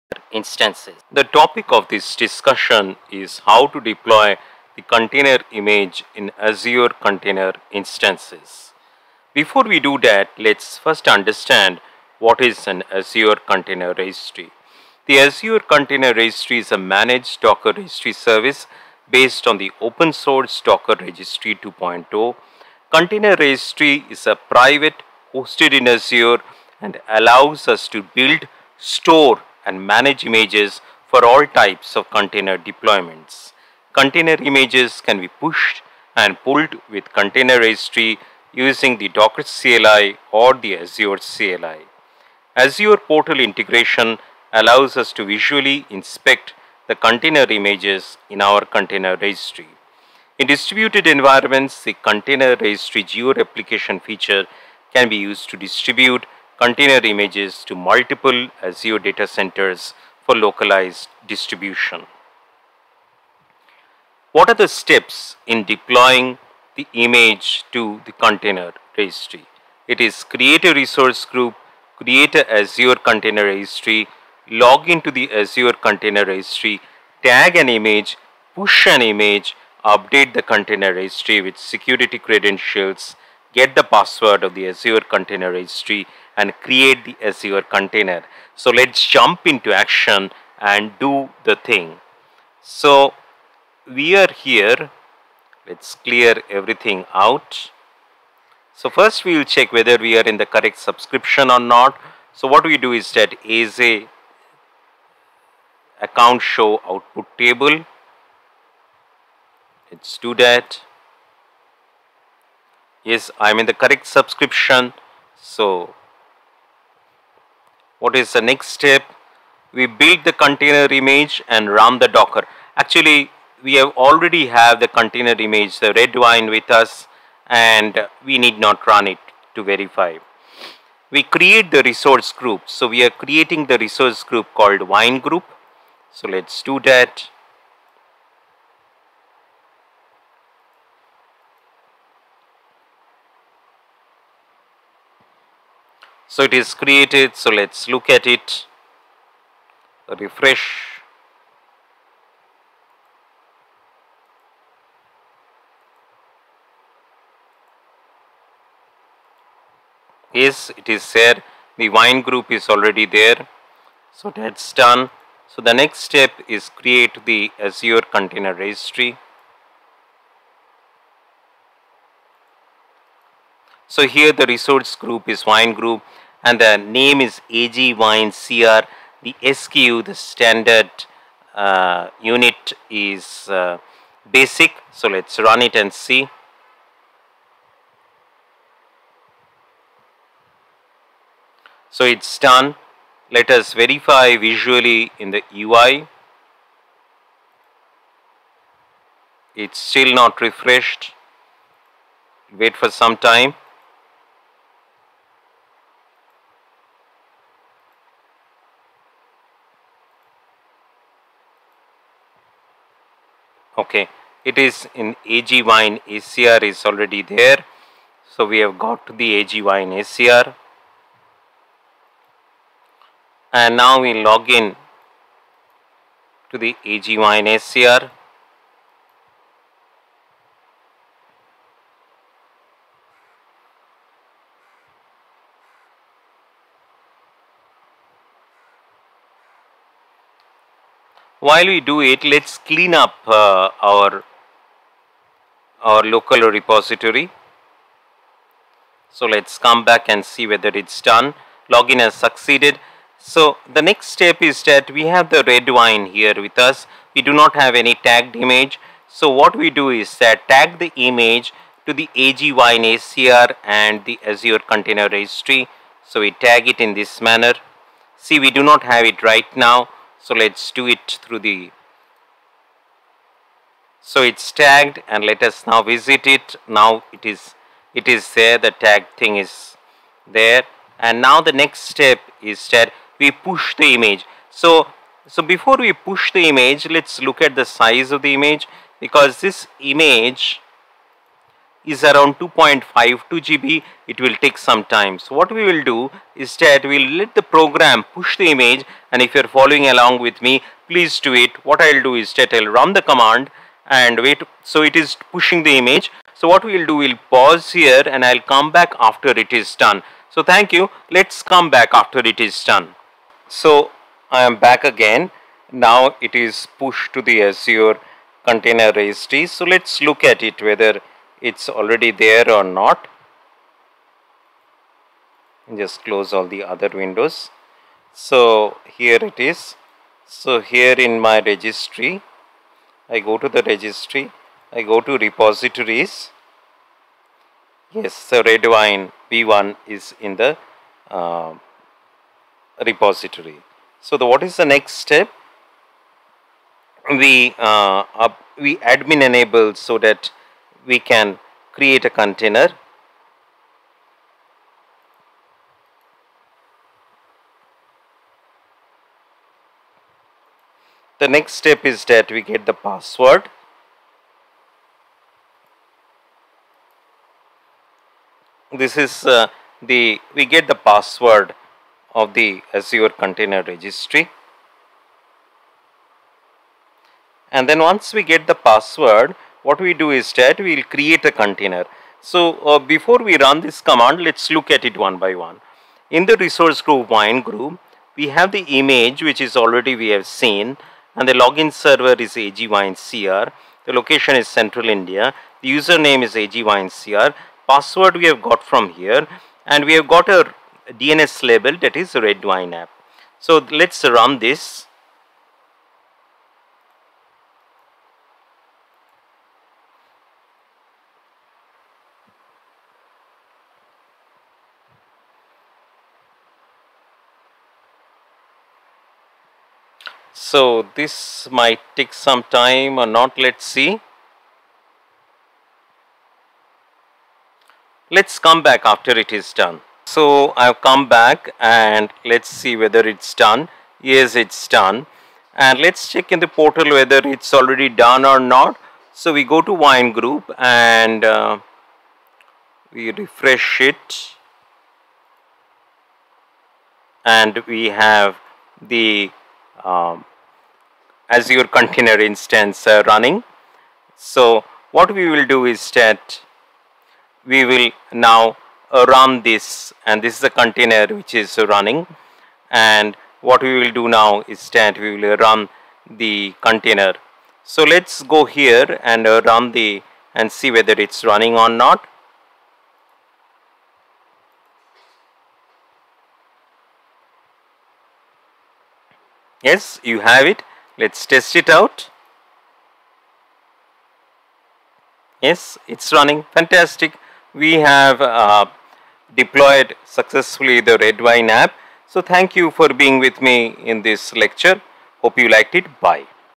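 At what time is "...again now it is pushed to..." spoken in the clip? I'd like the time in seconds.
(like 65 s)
314 s.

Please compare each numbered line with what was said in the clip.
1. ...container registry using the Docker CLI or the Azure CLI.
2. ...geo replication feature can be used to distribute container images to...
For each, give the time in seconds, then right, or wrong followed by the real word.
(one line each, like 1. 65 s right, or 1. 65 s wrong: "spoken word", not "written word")
1. 37 s right
2. 53 s right.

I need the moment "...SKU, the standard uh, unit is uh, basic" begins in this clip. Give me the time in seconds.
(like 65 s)
179 s.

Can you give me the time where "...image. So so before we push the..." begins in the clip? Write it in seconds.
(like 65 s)
283 s.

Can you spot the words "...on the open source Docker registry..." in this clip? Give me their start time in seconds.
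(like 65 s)
19 s.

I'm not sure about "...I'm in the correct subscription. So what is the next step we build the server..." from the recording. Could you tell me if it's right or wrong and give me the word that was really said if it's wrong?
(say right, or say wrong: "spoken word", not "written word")
wrong: "container", not "server".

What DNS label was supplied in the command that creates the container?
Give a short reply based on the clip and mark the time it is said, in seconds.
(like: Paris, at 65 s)
red wine app, at 402 s.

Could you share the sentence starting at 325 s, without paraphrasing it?
Just close all the other windows.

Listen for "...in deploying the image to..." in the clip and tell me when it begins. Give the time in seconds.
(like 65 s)
65 s.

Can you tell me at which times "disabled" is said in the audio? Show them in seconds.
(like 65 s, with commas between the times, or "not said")
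not said.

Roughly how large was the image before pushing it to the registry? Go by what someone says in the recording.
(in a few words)
2.52 GB.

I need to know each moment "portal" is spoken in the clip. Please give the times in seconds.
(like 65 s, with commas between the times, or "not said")
42 s, 436 s.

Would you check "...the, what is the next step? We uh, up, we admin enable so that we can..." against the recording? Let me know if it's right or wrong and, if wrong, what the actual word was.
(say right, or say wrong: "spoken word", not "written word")
right.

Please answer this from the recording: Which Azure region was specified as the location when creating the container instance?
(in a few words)
Central India.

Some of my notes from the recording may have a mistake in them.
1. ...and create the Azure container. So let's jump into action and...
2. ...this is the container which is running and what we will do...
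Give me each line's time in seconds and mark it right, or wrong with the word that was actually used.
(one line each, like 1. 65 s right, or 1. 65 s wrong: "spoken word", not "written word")
1. 86 s right
2. 460 s right.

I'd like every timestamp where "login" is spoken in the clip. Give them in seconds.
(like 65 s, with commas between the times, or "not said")
251 s, 391 s.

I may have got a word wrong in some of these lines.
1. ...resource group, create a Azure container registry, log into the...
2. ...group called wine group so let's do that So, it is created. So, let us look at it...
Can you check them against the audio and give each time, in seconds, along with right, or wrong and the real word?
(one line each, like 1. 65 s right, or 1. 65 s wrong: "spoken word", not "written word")
1. 70 s right
2. 134 s right.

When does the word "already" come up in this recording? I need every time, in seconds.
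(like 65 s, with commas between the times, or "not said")
124 s, 162 s, 216 s, 321 s, 389 s, 437 s.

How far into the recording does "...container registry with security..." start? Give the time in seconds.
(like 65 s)
80 s.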